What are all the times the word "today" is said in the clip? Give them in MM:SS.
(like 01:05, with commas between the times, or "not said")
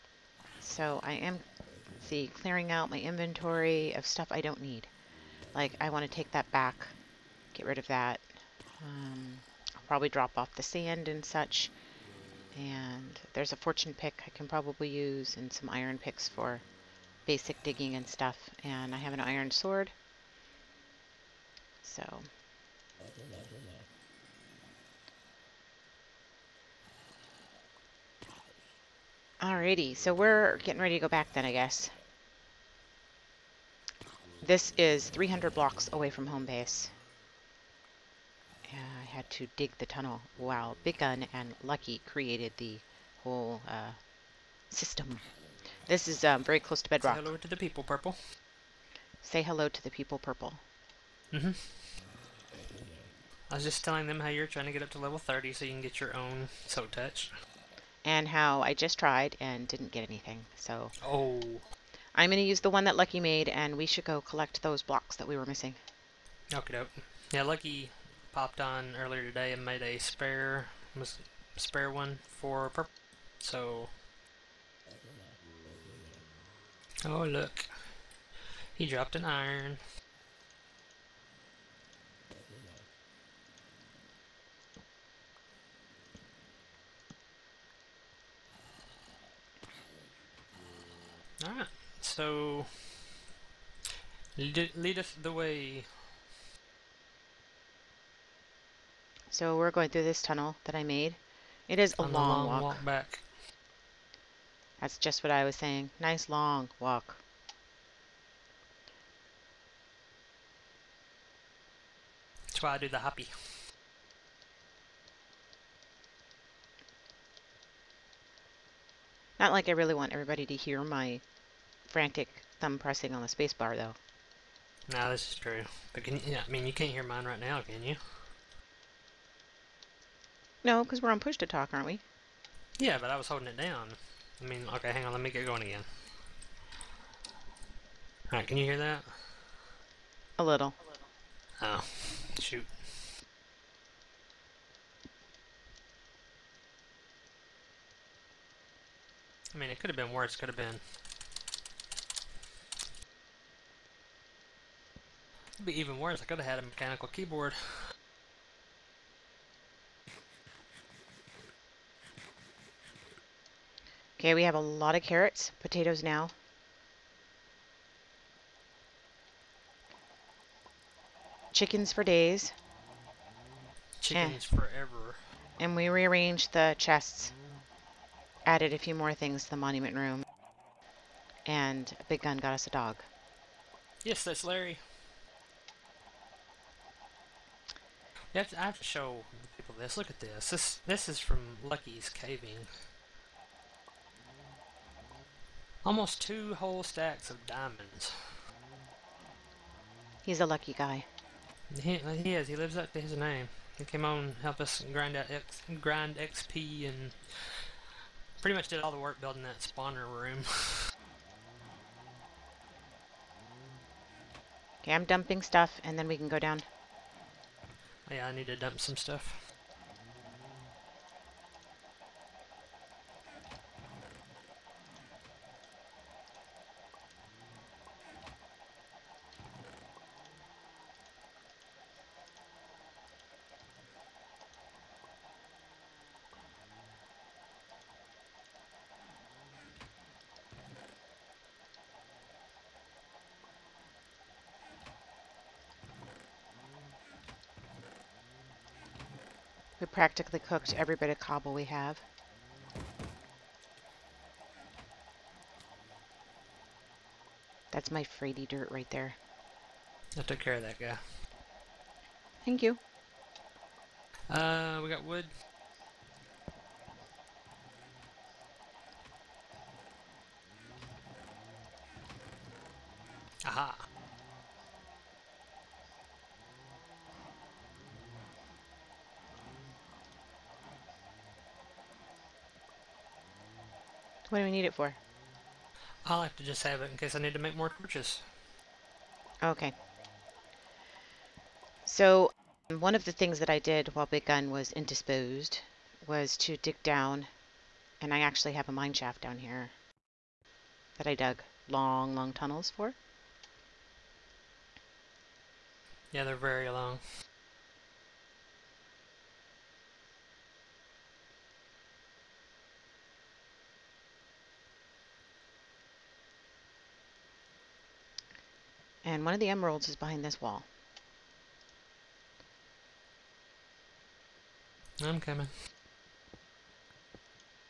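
01:09.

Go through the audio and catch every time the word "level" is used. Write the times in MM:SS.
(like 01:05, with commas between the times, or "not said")
00:54.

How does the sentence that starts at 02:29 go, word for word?
I mean, it could have been worse, could have been could be even worse.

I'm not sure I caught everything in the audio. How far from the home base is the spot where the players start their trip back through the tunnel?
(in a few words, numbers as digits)
300 blocks.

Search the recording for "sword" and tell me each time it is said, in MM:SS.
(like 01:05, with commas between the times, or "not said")
00:19.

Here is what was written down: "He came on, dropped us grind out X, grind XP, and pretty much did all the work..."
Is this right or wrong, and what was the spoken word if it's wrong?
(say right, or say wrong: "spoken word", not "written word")
wrong: "helped", not "dropped".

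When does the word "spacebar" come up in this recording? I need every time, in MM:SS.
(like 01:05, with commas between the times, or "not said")
02:03.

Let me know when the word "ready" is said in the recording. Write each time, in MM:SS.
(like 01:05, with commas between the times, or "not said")
00:30.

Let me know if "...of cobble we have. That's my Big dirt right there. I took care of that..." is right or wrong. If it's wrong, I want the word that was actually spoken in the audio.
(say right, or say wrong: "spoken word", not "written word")
wrong: "Frady", not "Big".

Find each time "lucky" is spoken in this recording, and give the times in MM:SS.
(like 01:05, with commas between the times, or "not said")
00:41, 01:02, 01:07, 03:11, 03:20.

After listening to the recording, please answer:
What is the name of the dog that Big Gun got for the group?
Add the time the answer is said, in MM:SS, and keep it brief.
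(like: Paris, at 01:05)
Larry, at 03:04.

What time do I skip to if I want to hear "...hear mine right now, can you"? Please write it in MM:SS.
02:06.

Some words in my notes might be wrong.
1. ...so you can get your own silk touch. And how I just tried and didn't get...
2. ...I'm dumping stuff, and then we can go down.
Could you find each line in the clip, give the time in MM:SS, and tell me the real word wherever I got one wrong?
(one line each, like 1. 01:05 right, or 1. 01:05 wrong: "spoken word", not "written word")
1. 00:55 right
2. 03:34 right.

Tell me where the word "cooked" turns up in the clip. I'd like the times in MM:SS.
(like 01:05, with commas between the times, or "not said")
04:10.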